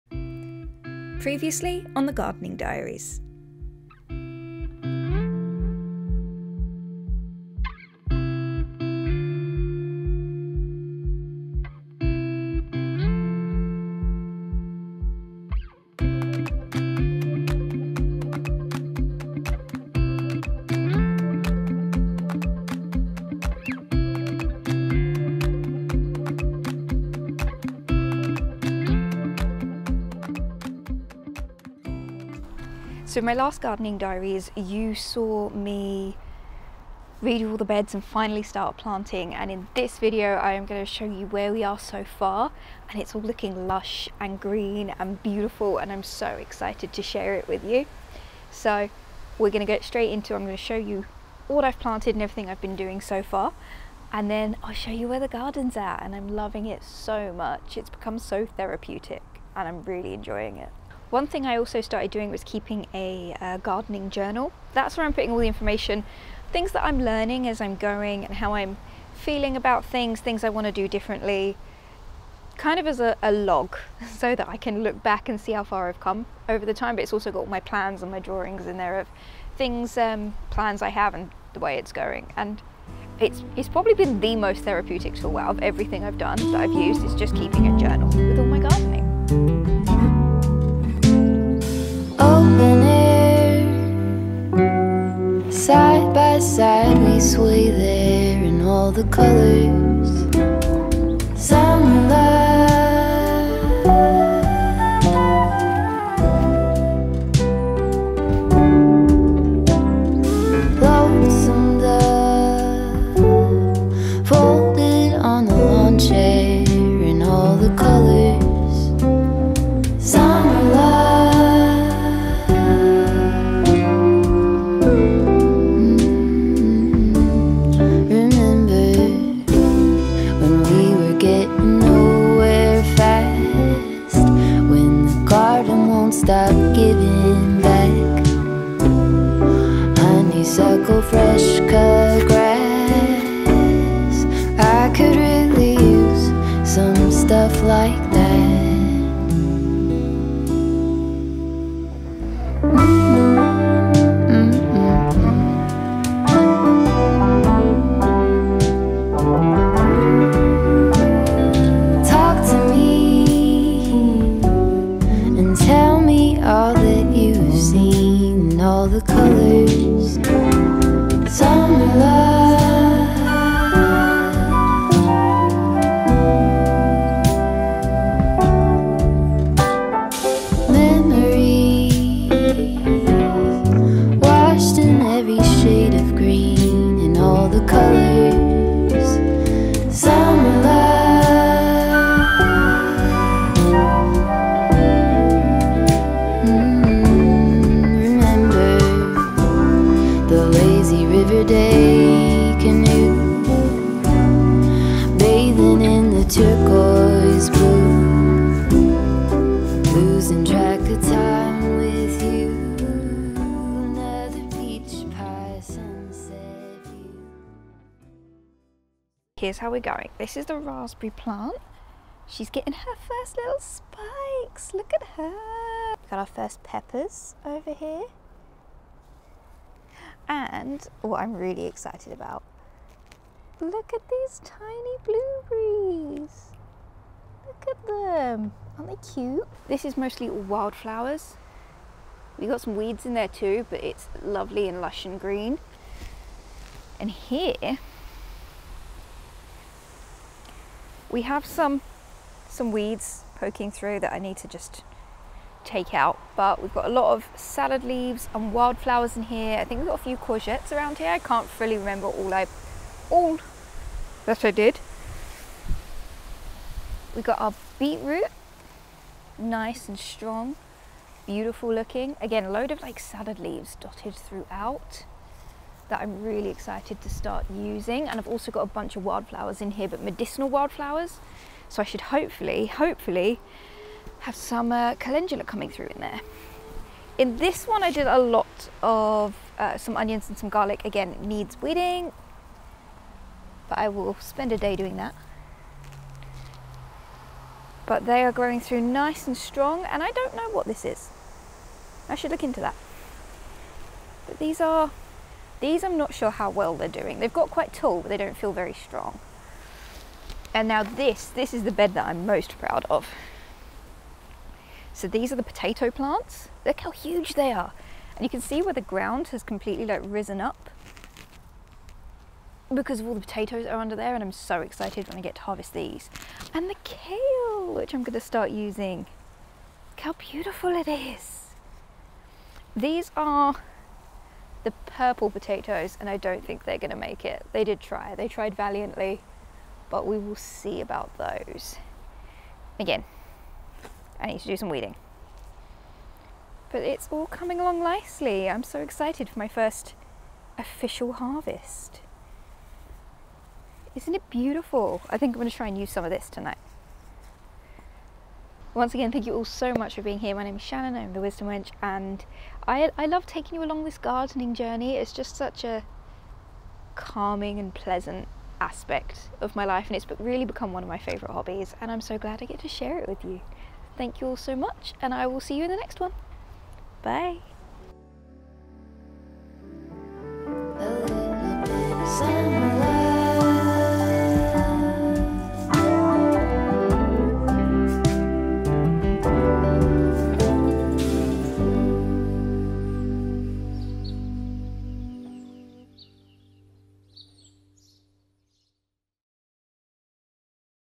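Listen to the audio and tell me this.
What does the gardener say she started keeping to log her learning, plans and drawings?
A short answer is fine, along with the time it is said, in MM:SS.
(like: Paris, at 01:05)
Gardening journal, at 01:03.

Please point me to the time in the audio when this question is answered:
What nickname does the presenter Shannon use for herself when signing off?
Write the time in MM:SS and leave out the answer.
06:01.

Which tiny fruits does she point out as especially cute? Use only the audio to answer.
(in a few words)
Blueberries.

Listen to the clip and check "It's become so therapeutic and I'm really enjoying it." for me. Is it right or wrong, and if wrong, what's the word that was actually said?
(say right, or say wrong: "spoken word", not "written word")
right.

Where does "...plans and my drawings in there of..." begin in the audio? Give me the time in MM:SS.
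01:17.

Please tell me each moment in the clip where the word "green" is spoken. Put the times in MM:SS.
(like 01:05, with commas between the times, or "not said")
00:44, 04:05.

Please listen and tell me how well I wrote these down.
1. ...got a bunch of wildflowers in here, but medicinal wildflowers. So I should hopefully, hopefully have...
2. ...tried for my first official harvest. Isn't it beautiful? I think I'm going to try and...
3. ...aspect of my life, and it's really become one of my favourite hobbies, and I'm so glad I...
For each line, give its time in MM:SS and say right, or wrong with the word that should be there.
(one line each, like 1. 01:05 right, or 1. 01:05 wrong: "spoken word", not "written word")
1. 04:38 right
2. 05:48 wrong: "excited", not "tried"
3. 06:08 right.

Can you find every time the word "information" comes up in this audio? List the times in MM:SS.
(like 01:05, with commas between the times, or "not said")
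01:05.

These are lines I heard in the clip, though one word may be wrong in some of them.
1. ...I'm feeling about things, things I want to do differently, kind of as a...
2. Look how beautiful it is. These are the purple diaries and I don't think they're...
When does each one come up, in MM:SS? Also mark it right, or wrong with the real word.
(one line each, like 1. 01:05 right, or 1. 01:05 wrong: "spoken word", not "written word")
1. 01:08 right
2. 05:29 wrong: "potatoes", not "diaries".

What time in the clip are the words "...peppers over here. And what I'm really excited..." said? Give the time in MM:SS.
03:46.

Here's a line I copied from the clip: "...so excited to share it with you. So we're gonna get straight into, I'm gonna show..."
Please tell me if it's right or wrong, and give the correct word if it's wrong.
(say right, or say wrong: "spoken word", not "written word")
right.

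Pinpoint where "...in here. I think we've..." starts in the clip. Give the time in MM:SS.
04:19.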